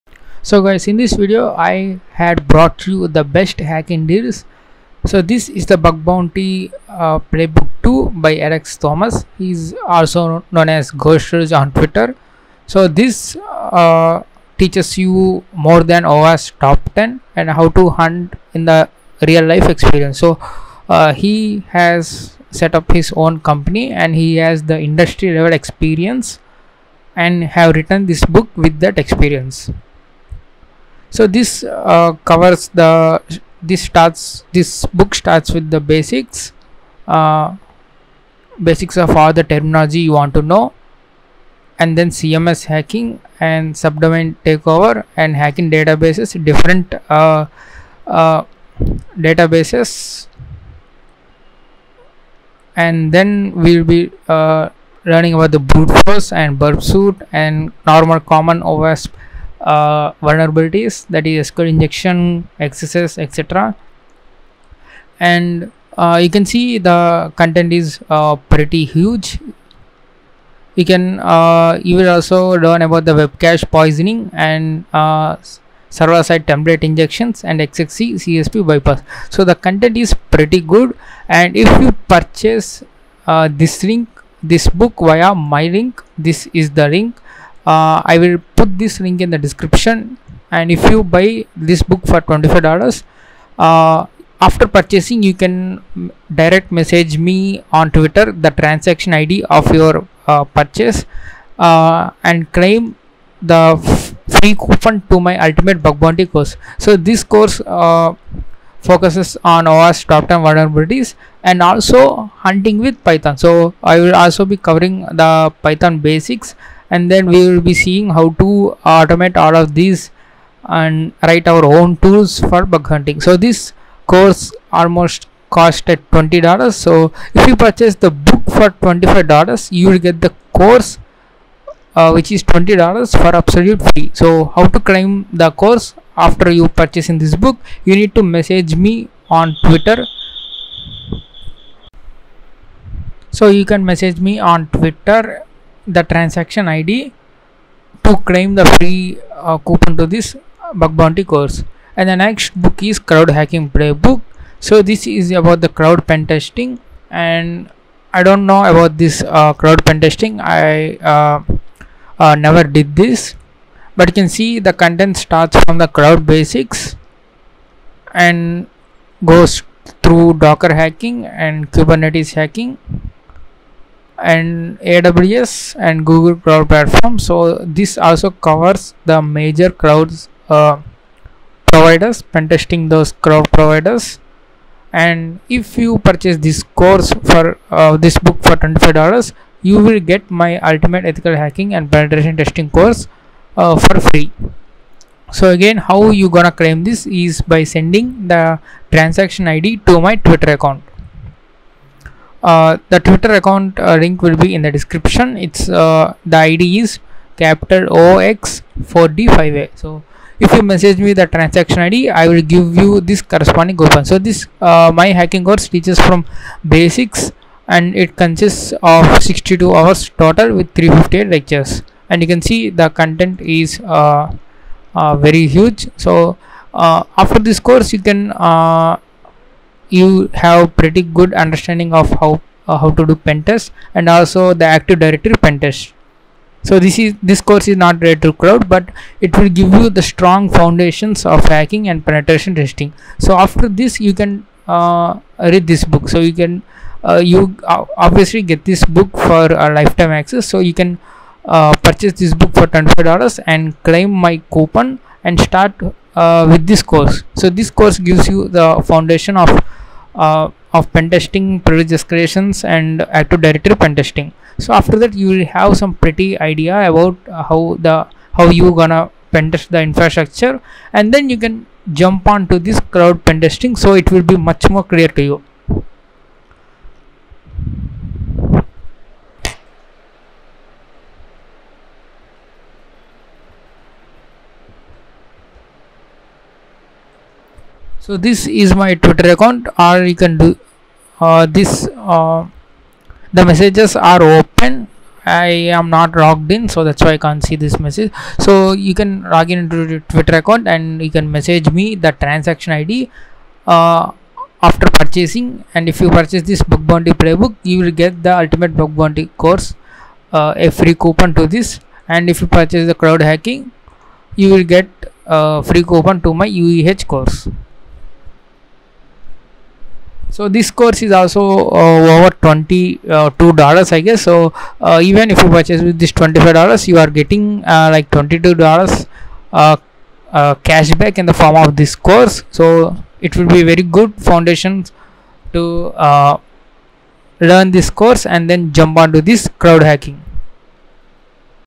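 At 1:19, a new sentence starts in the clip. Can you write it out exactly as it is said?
So the content is pretty good.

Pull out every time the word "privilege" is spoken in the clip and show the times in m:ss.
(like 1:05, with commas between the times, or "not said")
4:21.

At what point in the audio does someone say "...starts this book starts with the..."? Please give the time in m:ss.
0:33.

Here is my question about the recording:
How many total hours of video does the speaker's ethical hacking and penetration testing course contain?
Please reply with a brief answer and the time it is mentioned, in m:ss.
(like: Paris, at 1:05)
62 hours, at 3:39.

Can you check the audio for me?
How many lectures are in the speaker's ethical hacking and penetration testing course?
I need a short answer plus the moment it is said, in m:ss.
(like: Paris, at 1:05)
358, at 3:40.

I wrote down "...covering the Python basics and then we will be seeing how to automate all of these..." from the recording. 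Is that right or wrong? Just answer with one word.
right.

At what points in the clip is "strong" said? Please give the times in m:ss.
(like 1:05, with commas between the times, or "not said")
4:00.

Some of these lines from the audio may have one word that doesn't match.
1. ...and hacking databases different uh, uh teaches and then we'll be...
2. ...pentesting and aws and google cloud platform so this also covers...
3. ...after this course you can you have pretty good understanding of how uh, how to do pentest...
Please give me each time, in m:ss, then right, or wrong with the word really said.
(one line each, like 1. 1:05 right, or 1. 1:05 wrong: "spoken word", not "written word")
1. 0:45 wrong: "databases", not "teaches"
2. 2:52 wrong: "hacking", not "pentesting"
3. 3:46 right.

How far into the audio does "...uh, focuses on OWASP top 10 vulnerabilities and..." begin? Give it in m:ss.
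1:47.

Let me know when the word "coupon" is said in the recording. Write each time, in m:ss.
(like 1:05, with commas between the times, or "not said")
1:44, 2:29, 3:33, 4:14, 5:11, 5:15.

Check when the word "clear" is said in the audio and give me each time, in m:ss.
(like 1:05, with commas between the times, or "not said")
4:34.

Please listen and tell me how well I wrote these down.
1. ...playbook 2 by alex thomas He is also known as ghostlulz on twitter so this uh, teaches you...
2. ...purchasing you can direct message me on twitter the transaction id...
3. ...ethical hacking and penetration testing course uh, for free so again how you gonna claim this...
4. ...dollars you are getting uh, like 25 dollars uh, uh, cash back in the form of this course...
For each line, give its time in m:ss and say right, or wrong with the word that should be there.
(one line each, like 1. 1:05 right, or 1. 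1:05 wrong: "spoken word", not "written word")
1. 0:07 right
2. 1:34 right
3. 3:11 right
4. 5:26 wrong: "22", not "25".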